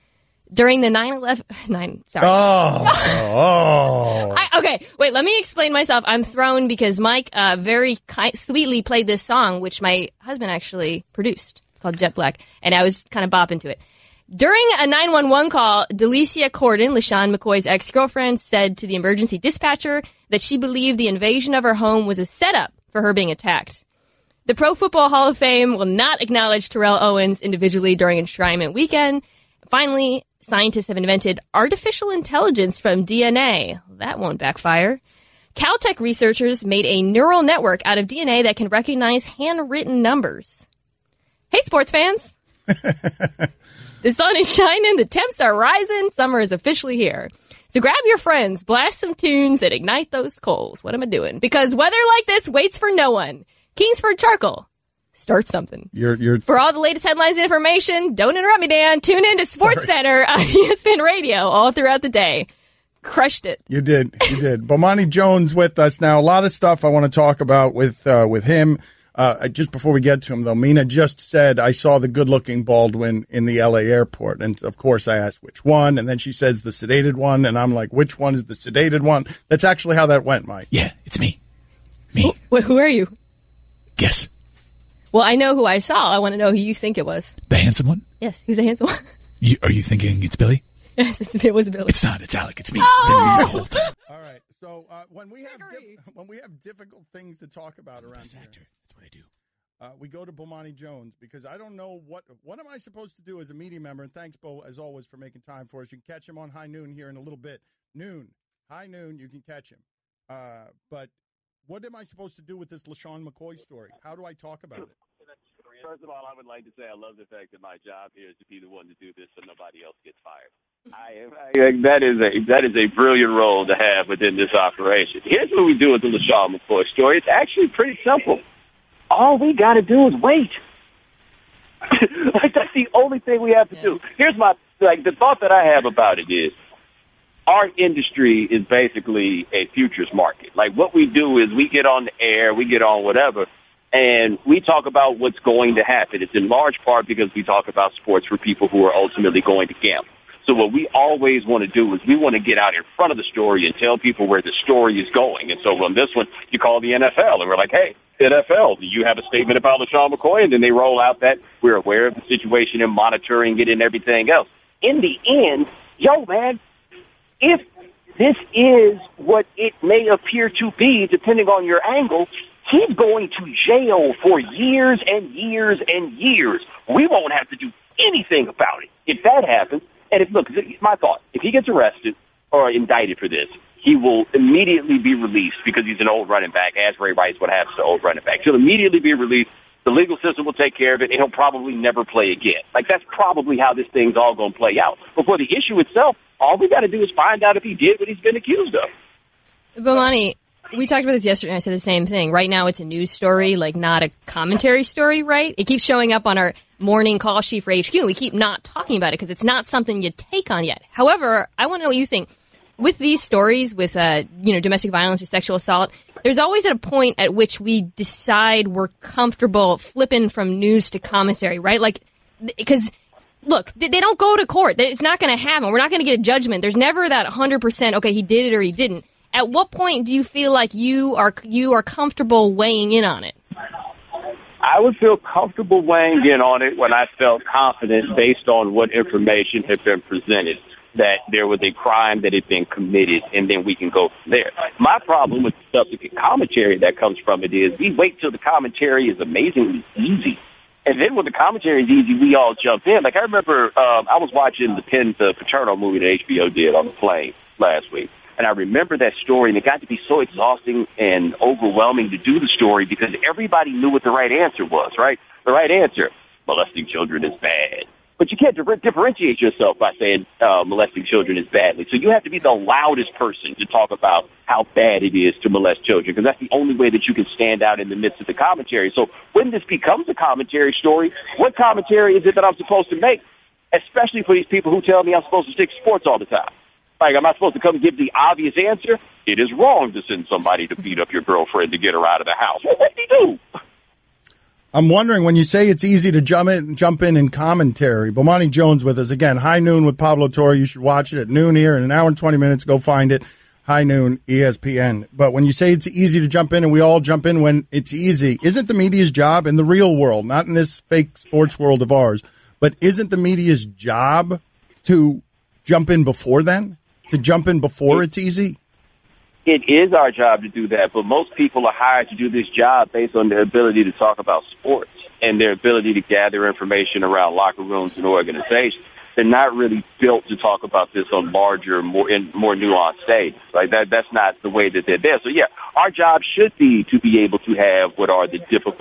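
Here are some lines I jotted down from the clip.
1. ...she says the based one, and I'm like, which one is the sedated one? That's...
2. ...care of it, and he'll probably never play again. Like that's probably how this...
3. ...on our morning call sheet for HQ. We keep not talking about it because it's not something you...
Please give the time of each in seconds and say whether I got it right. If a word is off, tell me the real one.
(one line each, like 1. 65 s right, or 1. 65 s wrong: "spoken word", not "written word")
1. 76 s wrong: "sedated", not "based"
2. 190 s right
3. 206 s right.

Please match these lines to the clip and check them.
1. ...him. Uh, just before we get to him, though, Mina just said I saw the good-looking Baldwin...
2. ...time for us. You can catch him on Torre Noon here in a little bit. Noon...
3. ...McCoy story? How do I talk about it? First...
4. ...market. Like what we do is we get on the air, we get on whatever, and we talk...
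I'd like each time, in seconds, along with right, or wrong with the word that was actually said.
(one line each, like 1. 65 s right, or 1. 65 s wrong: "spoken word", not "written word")
1. 68 s right
2. 105 s wrong: "High", not "Torre"
3. 113 s right
4. 140 s right.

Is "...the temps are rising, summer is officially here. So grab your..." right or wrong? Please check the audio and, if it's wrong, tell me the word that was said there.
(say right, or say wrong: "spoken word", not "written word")
right.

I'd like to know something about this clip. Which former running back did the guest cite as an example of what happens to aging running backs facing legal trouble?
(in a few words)
Ray Rice.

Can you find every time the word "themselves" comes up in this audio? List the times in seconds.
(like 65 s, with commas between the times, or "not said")
not said.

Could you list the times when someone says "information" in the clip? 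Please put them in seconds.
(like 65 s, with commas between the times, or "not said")
57 s, 238 s, 326 s.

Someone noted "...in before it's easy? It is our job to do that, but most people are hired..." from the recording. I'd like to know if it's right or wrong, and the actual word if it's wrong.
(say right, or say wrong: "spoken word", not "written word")
right.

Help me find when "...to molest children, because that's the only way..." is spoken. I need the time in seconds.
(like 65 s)
275 s.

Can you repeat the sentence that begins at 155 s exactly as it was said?
And so on this one, you call the NFL and we're like, hey, NFL, do you have a statement about LeSean McCoy?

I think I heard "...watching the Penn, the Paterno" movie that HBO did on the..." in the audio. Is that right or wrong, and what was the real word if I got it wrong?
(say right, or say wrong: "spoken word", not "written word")
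right.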